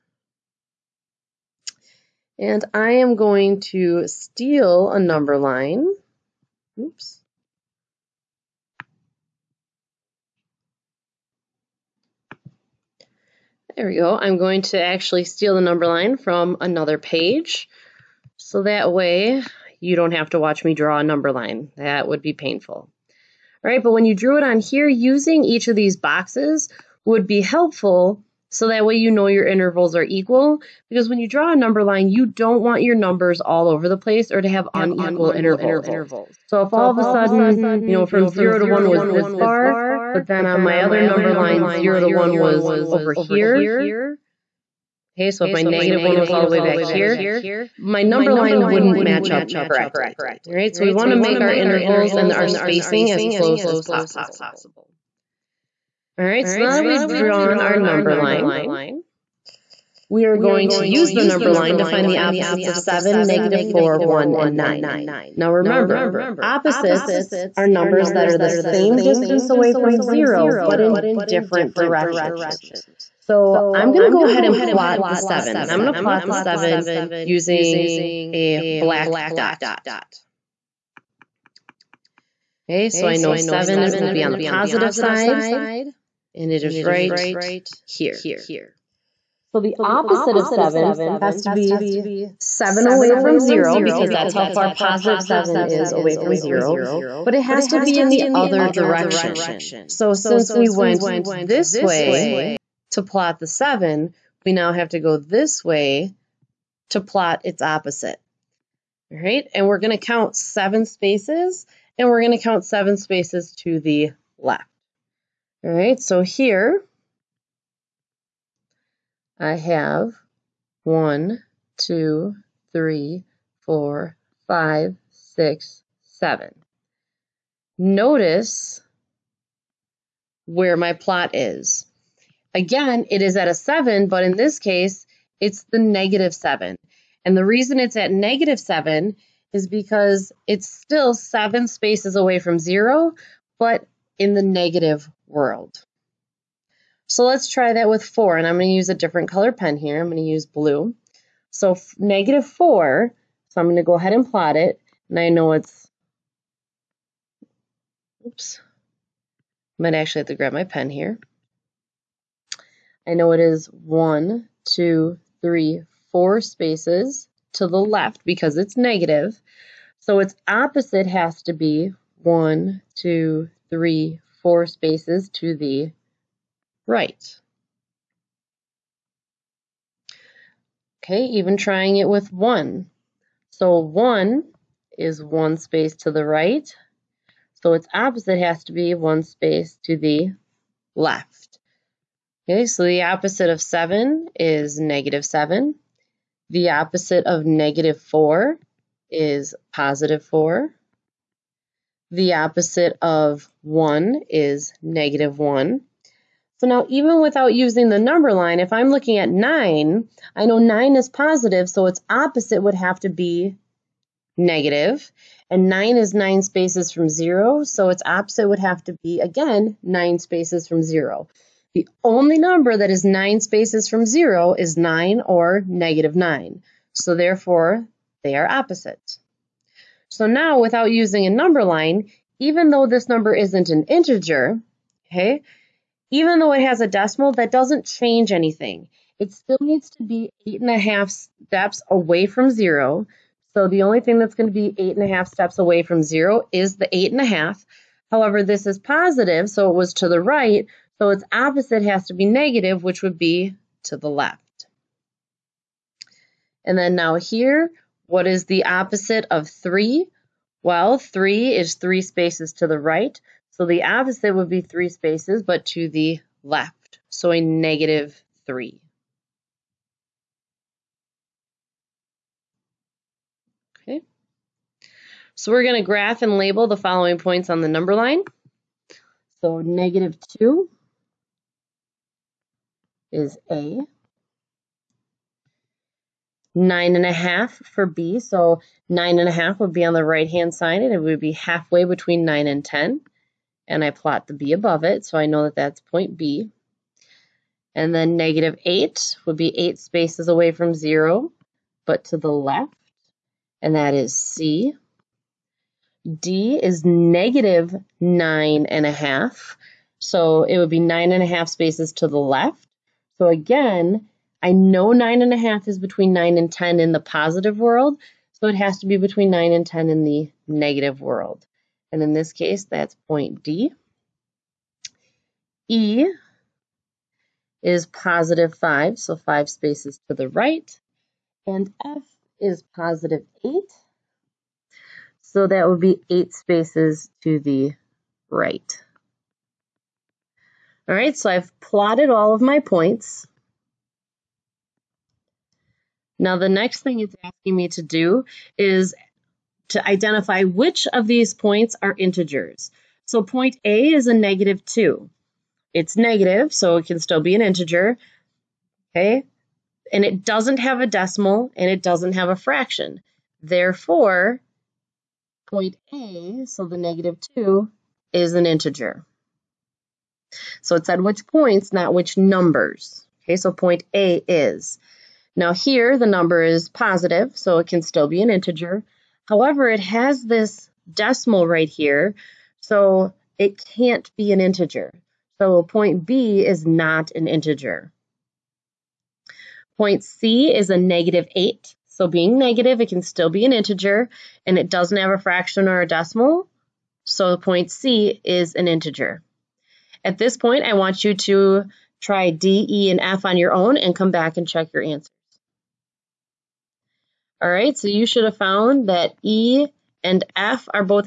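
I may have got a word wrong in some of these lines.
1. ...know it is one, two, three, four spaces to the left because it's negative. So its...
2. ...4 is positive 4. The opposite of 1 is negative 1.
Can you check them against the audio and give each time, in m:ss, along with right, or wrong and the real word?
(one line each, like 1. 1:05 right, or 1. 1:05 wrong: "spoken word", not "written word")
1. 2:43 right
2. 3:17 right.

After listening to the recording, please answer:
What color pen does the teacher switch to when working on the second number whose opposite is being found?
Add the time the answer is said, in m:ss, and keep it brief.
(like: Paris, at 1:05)
blue, at 2:30.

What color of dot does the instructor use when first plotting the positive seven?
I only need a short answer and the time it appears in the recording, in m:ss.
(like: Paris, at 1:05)
black, at 1:18.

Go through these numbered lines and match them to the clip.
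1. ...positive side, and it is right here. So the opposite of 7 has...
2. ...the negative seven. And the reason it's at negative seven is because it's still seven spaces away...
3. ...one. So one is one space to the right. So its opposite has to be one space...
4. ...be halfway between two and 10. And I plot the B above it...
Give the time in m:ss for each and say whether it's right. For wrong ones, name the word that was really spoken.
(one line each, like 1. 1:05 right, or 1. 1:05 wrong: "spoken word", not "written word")
1. 1:24 right
2. 2:15 right
3. 3:02 right
4. 4:51 wrong: "nine", not "two".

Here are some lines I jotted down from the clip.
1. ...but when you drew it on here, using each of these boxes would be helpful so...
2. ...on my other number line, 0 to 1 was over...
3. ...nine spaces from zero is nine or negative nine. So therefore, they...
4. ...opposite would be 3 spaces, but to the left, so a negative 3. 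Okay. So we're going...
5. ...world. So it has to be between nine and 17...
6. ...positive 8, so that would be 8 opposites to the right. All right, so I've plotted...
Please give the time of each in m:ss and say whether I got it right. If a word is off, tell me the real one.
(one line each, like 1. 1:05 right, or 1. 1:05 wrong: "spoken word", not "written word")
1. 0:23 right
2. 0:40 right
3. 3:43 right
4. 4:23 right
5. 5:17 wrong: "10", not "17"
6. 5:32 wrong: "spaces", not "opposites".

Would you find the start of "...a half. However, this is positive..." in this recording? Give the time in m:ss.
4:07.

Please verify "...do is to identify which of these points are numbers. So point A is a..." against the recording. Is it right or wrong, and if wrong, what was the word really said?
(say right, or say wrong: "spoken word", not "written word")
wrong: "integers", not "numbers".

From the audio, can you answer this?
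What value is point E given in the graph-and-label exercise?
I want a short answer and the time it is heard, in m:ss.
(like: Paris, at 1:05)
positive 5, at 5:27.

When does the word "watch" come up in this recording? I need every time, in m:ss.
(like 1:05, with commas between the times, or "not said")
0:20.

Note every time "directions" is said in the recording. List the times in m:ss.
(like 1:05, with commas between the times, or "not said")
1:11, 1:38.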